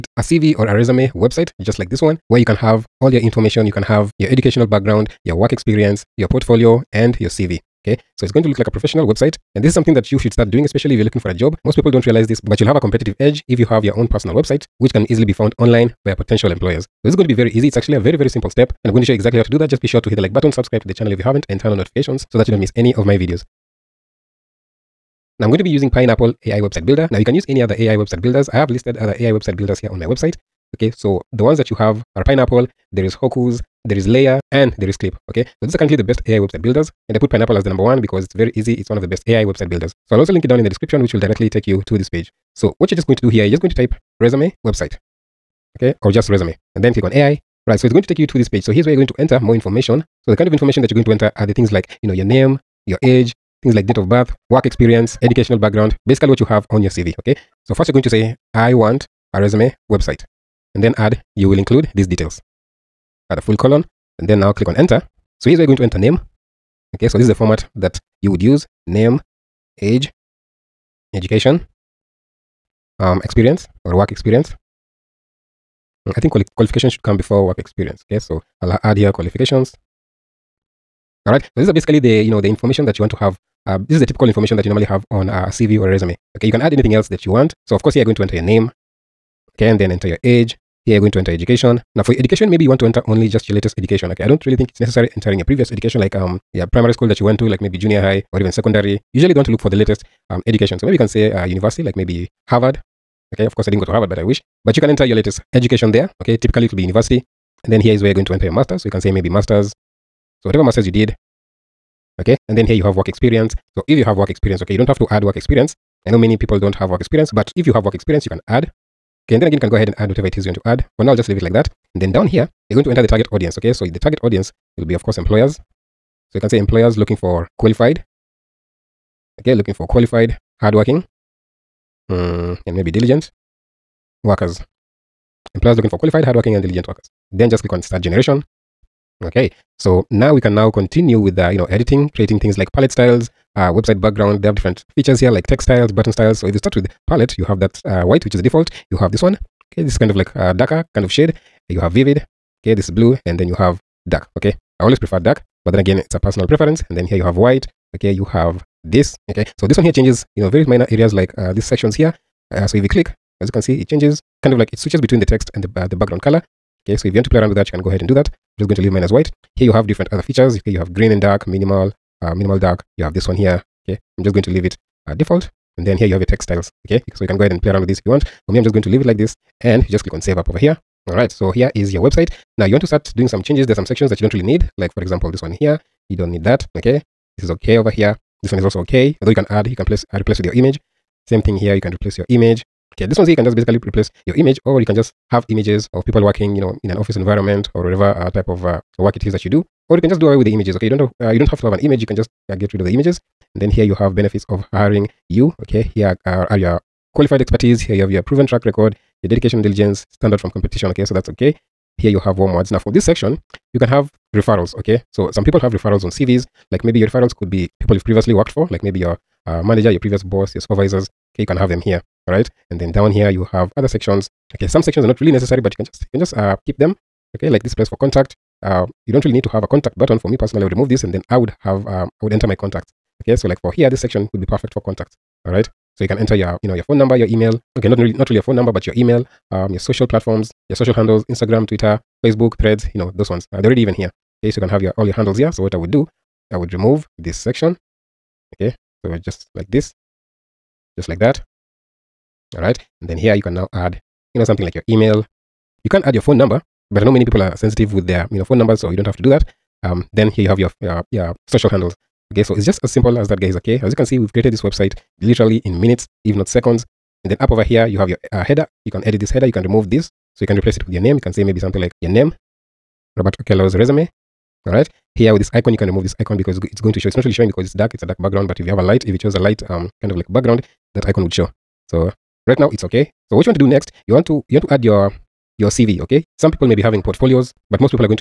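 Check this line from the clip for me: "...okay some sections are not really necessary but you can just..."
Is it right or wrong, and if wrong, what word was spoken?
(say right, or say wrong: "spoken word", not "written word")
right.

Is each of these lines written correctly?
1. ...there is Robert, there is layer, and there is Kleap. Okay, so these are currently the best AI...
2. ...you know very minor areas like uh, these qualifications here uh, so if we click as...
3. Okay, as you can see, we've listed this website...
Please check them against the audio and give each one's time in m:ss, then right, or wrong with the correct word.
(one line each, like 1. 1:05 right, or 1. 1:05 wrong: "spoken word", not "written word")
1. 0:32 wrong: "Hocoos", not "Robert"
2. 2:40 wrong: "sections", not "qualifications"
3. 4:23 wrong: "created", not "listed".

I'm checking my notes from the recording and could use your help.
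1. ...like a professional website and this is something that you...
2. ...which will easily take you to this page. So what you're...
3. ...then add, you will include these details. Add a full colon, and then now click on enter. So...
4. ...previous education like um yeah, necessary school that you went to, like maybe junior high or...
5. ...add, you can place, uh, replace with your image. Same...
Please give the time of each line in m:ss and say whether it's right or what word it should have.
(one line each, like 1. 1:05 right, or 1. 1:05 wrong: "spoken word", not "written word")
1. 0:08 right
2. 0:41 wrong: "directly", not "easily"
3. 1:00 right
4. 1:35 wrong: "primary", not "necessary"
5. 3:09 right.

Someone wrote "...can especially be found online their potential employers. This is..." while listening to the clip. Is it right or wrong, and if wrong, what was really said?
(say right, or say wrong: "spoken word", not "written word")
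wrong: "easily", not "especially".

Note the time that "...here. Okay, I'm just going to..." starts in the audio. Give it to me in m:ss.
2:53.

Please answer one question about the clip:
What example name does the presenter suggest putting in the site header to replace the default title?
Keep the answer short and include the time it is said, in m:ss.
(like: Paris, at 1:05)
Robert Okello, at 4:33.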